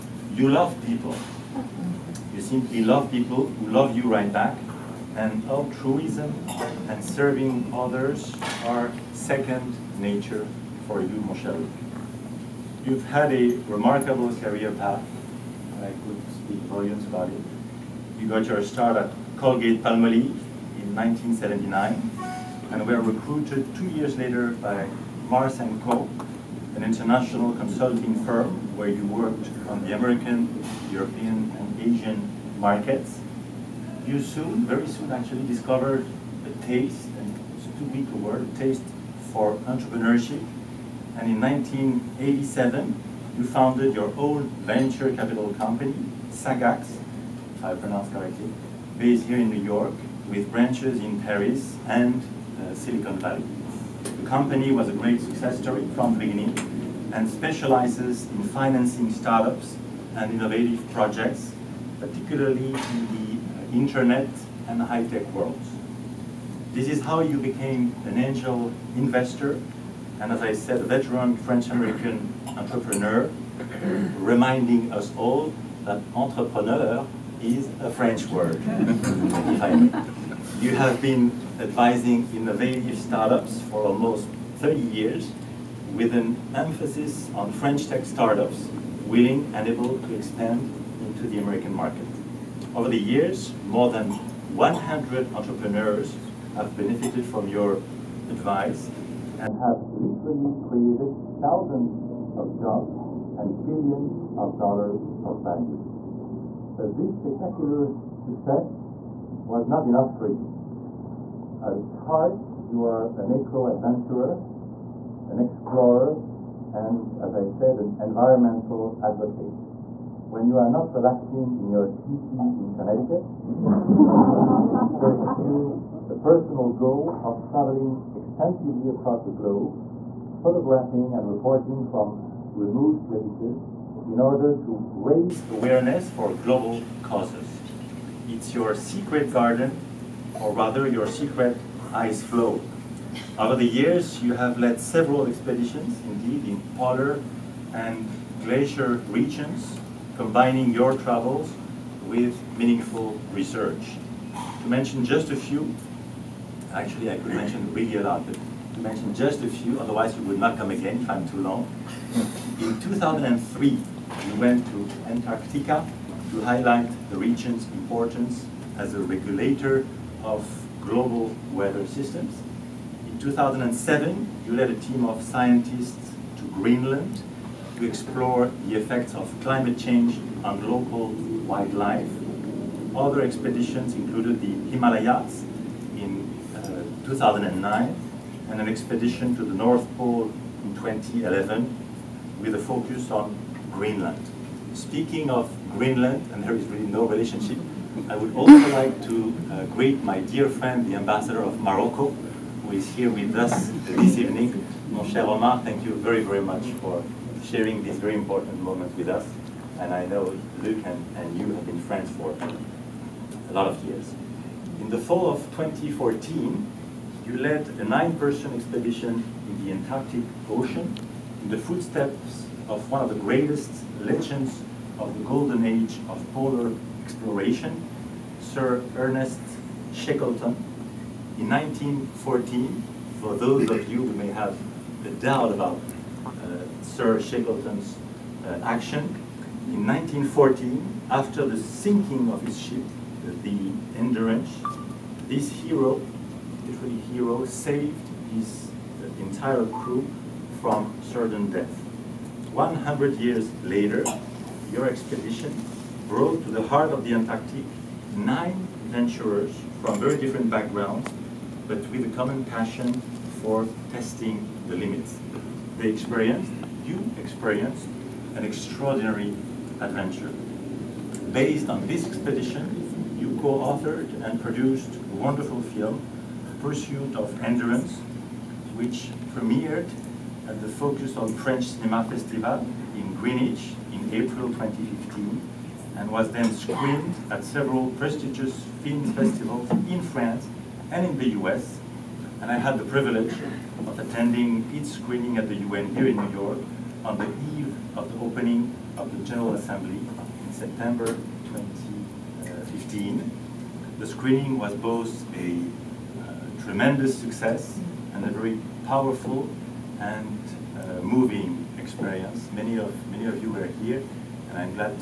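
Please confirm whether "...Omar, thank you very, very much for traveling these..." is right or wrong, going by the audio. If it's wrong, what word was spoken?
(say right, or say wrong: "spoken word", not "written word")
wrong: "sharing", not "traveling".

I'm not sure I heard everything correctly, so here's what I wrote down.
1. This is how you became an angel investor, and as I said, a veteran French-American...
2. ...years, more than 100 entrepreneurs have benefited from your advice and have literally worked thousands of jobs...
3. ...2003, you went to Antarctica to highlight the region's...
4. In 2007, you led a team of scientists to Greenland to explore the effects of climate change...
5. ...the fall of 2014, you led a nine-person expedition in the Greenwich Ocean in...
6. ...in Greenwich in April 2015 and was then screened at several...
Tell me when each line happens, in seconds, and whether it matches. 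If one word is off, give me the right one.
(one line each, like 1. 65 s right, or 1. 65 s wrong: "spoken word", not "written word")
1. 66 s right
2. 92 s wrong: "created", not "worked"
3. 162 s right
4. 173 s right
5. 214 s wrong: "Antarctic", not "Greenwich"
6. 282 s right.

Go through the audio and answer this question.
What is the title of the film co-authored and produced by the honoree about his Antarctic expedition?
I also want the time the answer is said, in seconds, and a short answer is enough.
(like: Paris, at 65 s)
Pursuit of Endurance, at 276 s.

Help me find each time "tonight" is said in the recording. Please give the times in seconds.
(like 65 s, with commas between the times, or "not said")
not said.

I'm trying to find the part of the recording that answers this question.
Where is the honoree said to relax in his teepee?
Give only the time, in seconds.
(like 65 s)
122 s.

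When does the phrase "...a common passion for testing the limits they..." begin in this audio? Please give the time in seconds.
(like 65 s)
262 s.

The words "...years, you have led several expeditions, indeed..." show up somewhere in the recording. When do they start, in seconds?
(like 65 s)
143 s.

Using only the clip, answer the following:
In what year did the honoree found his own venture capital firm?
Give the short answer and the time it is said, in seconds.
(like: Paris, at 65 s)
1987, at 41 s.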